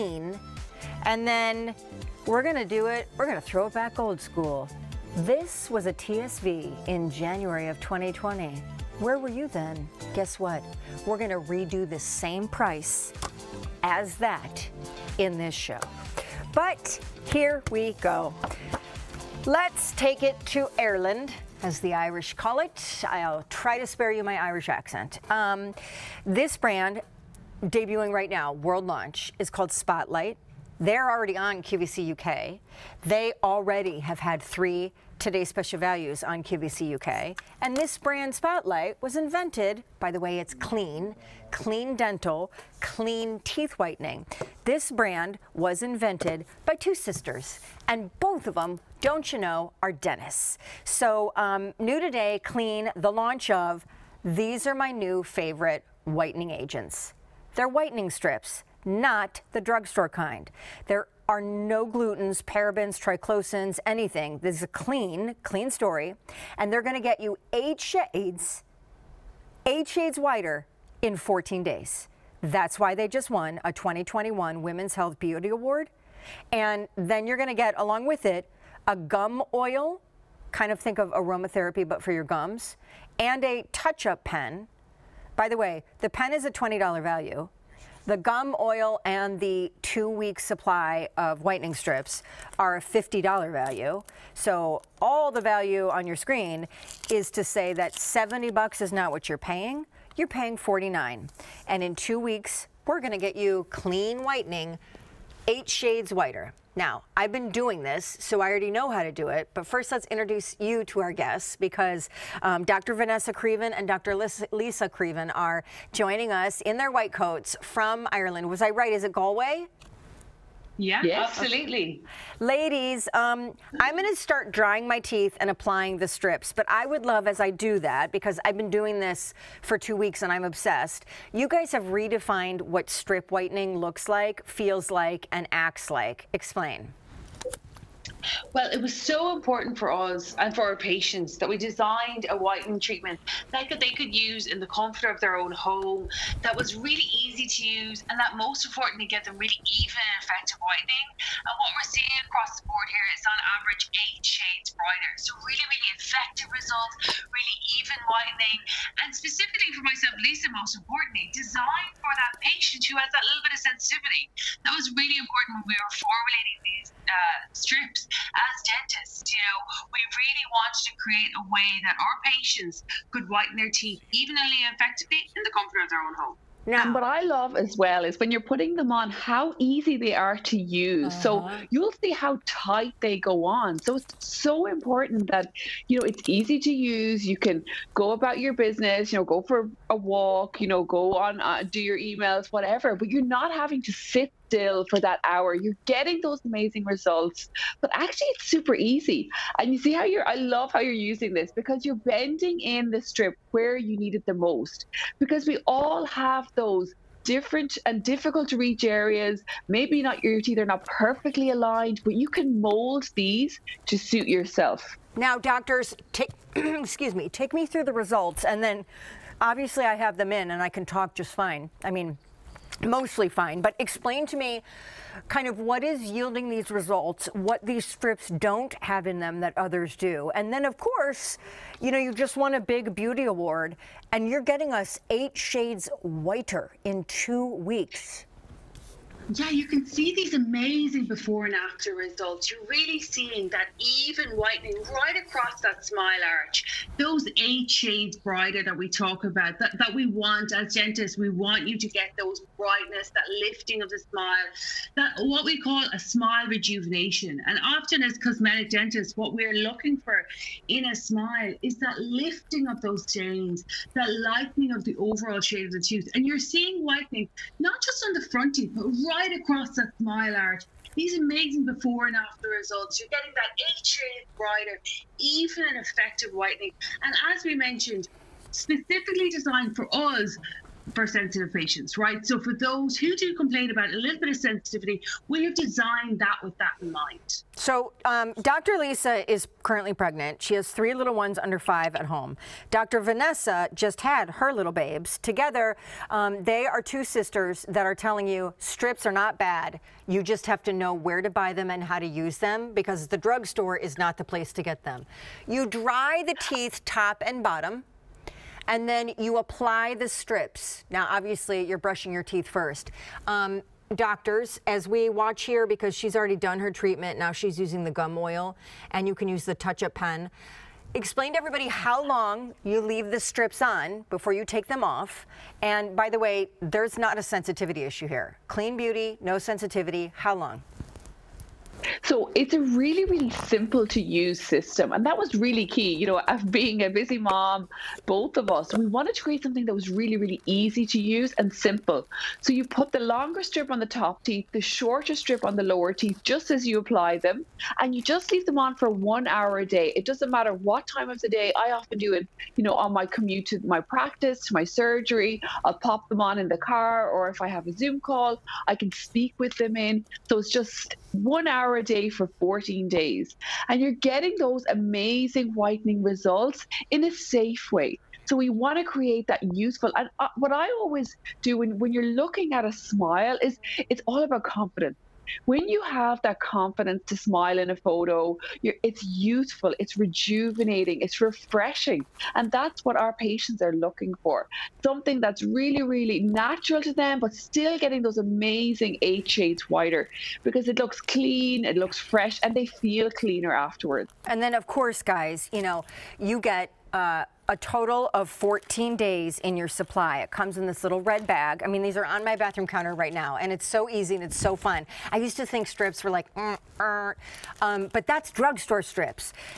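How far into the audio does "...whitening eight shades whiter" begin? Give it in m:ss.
1:44.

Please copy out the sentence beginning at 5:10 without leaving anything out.
Now, obviously, you're brushing your teeth first.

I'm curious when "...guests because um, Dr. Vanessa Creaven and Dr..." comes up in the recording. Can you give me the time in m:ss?
1:51.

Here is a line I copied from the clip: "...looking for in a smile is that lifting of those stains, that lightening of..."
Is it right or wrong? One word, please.
right.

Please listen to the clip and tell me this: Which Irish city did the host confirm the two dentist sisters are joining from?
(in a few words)
Galway.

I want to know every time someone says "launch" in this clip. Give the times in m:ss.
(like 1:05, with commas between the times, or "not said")
0:28, 0:53.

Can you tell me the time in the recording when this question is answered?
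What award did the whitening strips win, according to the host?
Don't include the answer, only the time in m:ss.
1:13.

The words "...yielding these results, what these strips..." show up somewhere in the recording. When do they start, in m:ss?
3:46.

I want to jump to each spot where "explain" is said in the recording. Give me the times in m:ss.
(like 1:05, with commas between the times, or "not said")
2:16, 3:43, 5:20.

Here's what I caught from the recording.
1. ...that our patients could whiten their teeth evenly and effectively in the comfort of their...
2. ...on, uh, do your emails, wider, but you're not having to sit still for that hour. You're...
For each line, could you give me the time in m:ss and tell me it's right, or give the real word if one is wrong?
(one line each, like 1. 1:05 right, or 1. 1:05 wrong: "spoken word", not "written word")
1. 2:51 right
2. 3:11 wrong: "whatever", not "wider".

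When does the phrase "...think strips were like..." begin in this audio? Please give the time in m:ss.
6:45.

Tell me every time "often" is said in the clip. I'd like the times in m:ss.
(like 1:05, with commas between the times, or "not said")
4:17, 5:51.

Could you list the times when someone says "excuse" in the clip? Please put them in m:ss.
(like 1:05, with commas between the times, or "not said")
3:36.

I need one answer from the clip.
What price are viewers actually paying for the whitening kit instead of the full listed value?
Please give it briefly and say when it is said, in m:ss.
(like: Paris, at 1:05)
$49, at 1:40.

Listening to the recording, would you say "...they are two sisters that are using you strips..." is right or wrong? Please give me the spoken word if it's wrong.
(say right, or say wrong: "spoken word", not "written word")
wrong: "telling", not "using".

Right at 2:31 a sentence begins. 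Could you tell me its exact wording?
And what we're seeing across the board here is on average eight shades brighter.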